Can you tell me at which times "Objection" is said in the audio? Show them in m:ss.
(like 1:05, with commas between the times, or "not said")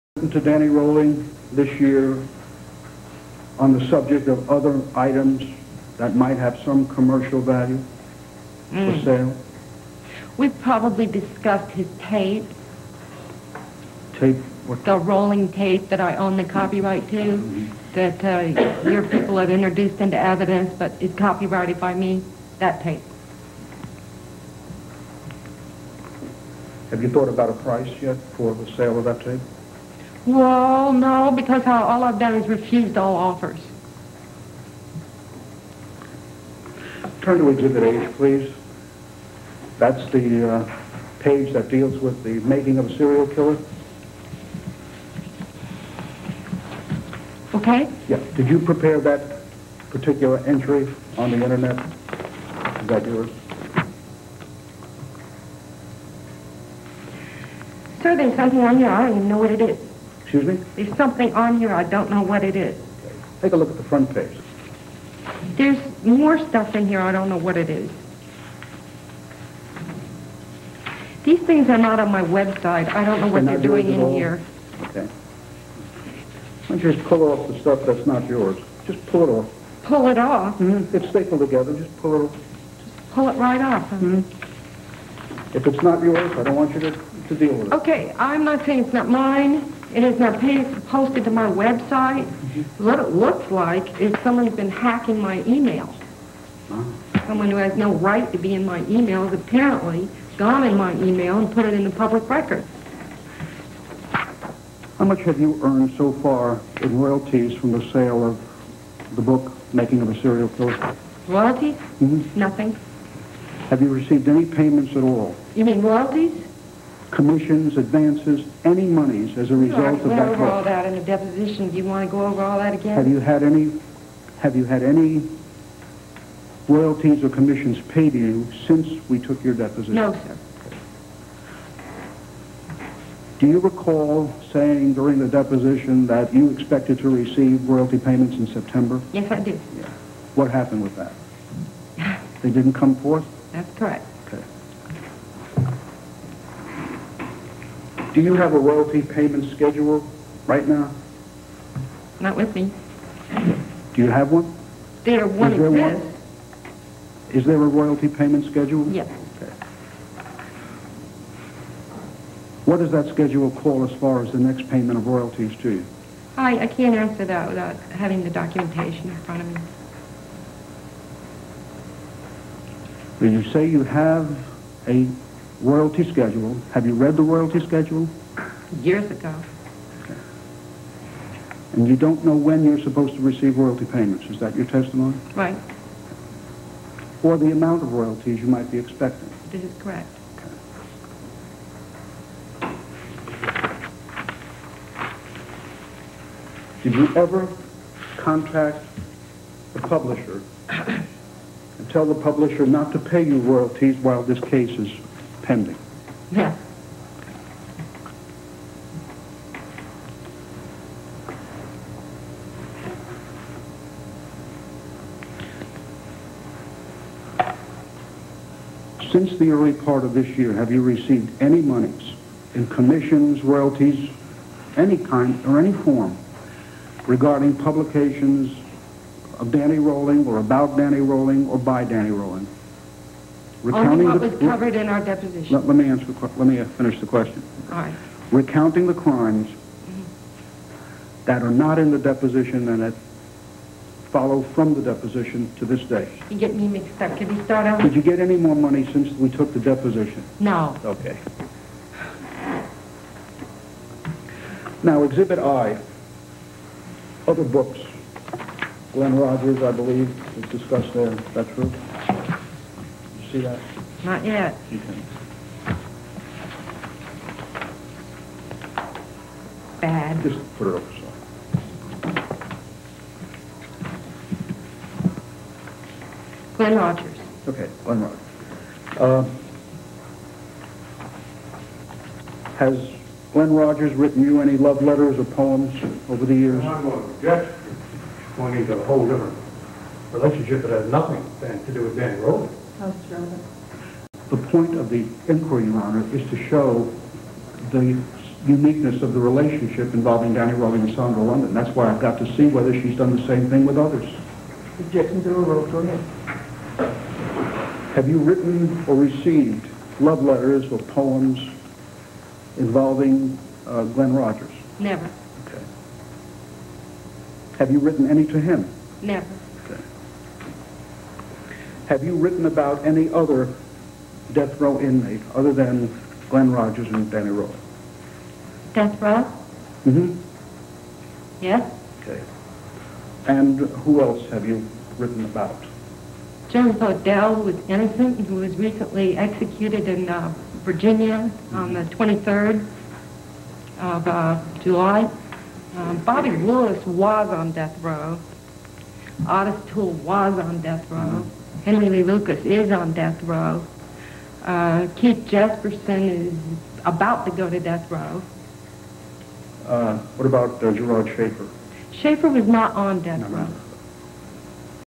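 5:04.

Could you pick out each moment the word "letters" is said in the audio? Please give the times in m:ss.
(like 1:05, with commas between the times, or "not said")
4:44, 5:10.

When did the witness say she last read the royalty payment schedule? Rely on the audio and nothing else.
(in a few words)
Years ago.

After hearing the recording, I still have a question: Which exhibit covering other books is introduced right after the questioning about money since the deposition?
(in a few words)
Exhibit I.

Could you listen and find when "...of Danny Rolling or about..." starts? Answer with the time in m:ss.
3:49.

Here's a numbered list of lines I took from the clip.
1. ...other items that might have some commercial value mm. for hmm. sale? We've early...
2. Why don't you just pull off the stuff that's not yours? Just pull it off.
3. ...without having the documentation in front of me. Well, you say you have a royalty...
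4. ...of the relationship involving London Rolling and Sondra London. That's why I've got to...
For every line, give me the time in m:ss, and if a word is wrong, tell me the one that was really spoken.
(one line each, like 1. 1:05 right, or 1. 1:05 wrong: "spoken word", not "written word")
1. 0:04 wrong: "probably", not "early"
2. 1:16 right
3. 2:47 right
4. 4:59 wrong: "Danny", not "London".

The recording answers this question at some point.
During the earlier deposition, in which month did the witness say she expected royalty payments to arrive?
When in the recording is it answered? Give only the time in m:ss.
2:18.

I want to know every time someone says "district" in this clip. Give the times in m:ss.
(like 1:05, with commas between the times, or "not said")
not said.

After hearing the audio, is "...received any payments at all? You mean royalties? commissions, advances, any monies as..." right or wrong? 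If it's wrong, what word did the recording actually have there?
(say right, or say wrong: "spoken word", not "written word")
right.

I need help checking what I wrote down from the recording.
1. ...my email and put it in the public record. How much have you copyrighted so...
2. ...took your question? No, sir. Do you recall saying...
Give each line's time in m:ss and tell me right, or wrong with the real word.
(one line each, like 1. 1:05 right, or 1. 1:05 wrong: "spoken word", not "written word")
1. 1:40 wrong: "earned", not "copyrighted"
2. 2:09 wrong: "deposition", not "question".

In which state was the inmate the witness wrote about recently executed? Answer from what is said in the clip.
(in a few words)
Virginia.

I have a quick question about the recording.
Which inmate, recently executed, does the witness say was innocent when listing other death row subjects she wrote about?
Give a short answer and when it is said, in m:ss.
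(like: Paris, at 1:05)
James Odell, at 5:36.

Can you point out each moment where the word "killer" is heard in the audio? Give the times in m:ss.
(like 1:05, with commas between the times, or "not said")
0:43, 1:50.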